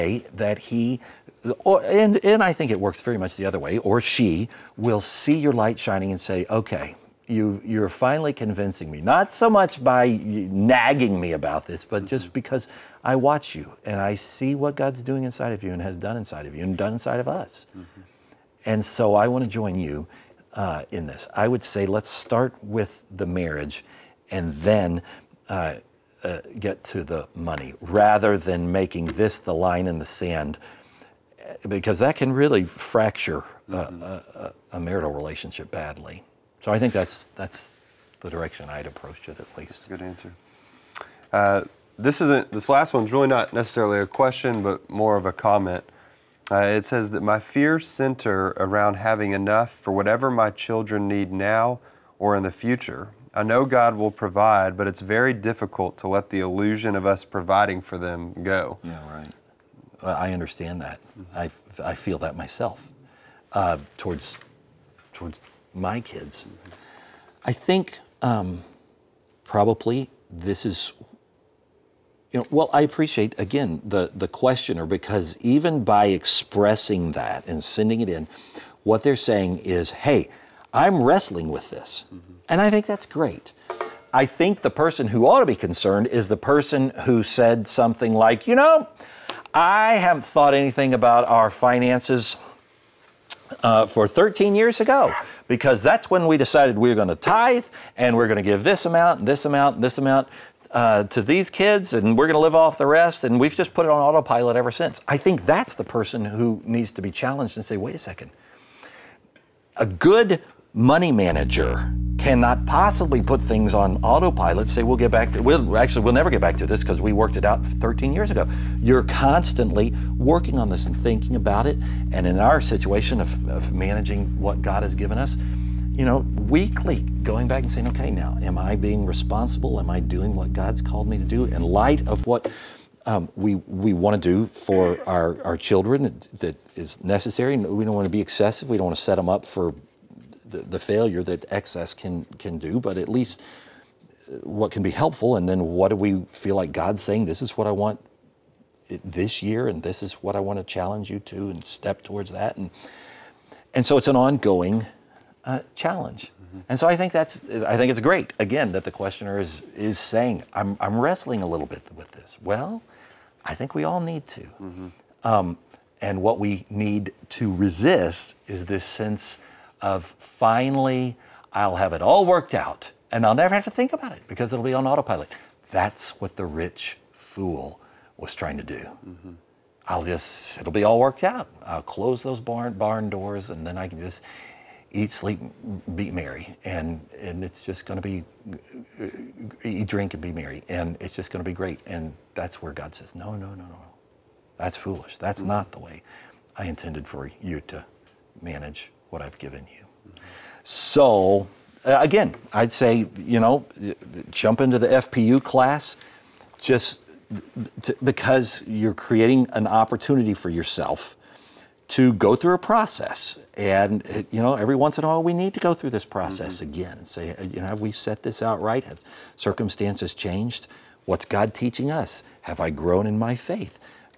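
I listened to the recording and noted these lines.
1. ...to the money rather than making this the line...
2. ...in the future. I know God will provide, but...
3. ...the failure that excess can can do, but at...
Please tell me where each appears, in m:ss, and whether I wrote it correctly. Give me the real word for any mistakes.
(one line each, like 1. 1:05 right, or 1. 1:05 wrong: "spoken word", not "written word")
1. 0:26 right
2. 0:52 right
3. 2:20 right.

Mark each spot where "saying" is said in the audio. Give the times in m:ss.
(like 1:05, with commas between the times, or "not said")
1:19, 2:07, 2:27, 2:39.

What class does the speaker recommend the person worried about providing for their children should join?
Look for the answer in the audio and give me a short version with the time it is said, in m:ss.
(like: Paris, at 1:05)
FPU, at 3:24.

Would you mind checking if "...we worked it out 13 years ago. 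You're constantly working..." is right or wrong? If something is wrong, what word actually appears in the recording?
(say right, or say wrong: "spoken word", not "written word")
right.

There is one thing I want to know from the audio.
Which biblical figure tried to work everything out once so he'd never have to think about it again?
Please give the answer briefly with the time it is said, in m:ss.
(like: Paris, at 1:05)
The rich fool, at 2:56.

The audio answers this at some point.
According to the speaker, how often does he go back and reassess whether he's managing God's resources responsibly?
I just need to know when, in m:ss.
2:06.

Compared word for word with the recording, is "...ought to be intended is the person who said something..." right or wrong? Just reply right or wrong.
wrong.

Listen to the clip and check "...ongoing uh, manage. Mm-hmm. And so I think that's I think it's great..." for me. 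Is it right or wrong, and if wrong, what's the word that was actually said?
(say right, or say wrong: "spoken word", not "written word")
wrong: "challenge", not "manage".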